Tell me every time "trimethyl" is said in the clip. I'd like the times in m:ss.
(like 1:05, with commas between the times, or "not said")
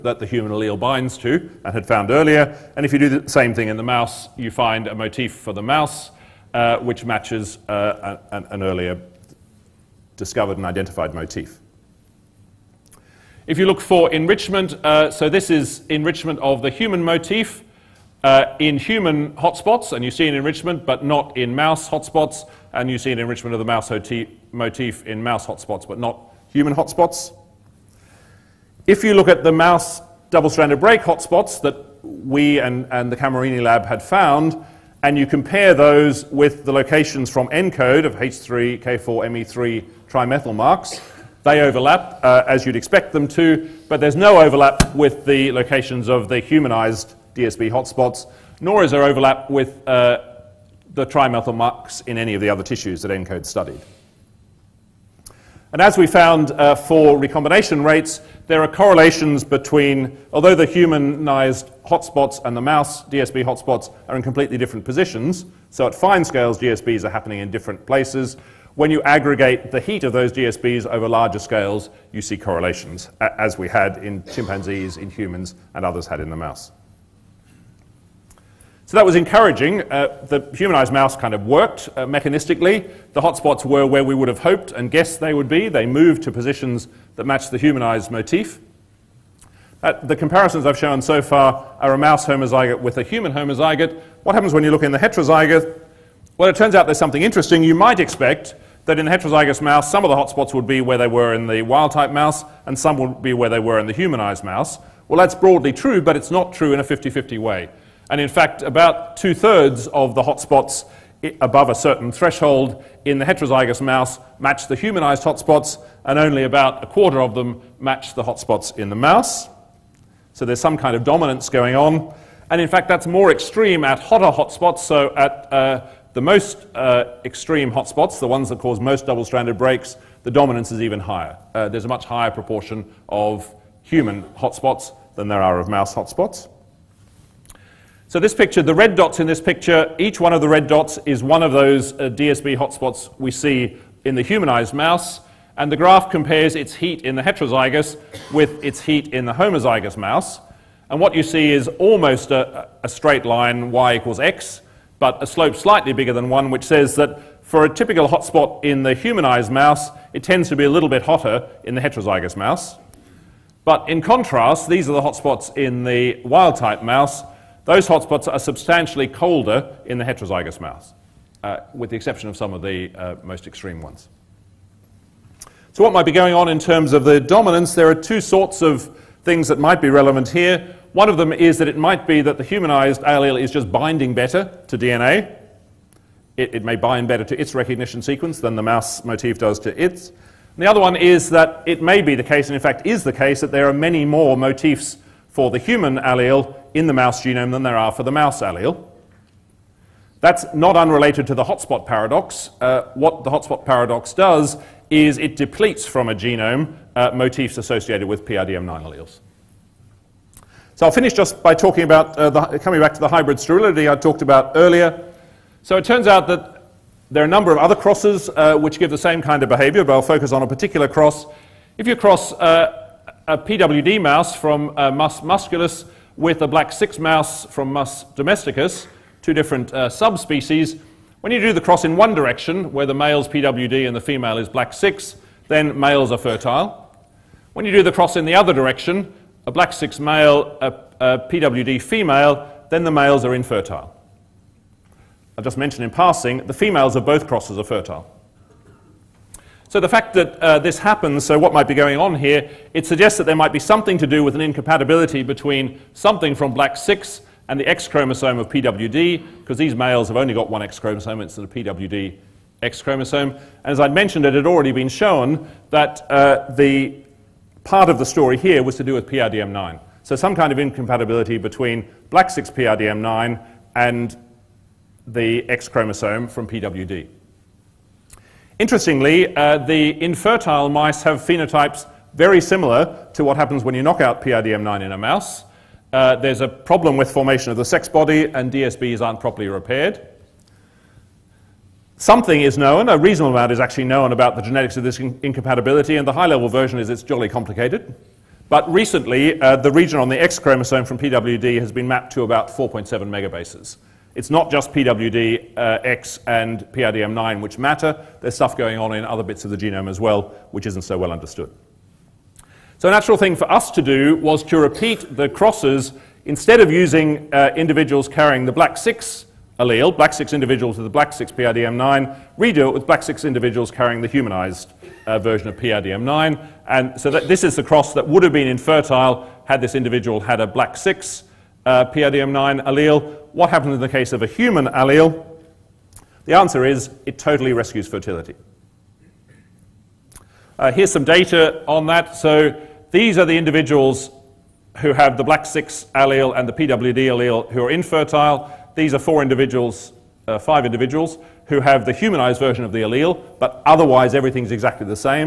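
0:40, 0:51.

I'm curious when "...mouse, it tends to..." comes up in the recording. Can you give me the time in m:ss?
2:39.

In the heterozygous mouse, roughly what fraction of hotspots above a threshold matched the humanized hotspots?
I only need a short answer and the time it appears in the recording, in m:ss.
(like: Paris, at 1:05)
two thirds, at 1:49.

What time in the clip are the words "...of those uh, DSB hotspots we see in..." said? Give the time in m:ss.
2:21.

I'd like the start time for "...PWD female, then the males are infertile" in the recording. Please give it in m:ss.
4:01.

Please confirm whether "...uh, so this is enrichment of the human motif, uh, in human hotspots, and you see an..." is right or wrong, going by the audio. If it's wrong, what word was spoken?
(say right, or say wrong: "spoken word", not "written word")
right.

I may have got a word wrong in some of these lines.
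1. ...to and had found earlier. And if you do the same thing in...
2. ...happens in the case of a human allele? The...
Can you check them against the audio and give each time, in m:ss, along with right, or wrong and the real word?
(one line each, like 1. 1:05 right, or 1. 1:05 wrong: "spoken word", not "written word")
1. 0:01 right
2. 5:33 right.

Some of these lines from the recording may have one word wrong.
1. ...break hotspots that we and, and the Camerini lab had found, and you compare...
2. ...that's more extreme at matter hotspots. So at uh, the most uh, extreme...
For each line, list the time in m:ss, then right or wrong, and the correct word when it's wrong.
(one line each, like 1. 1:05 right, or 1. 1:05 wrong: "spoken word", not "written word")
1. 0:30 right
2. 2:02 wrong: "hotter", not "matter".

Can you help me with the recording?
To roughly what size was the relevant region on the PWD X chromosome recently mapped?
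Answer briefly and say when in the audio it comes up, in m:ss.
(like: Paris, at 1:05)
4.7 megabases, at 5:02.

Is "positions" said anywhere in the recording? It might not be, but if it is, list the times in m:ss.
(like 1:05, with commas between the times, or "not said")
1:04, 1:26.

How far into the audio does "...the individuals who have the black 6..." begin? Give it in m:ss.
5:43.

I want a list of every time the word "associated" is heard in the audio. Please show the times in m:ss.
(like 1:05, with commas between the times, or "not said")
3:27.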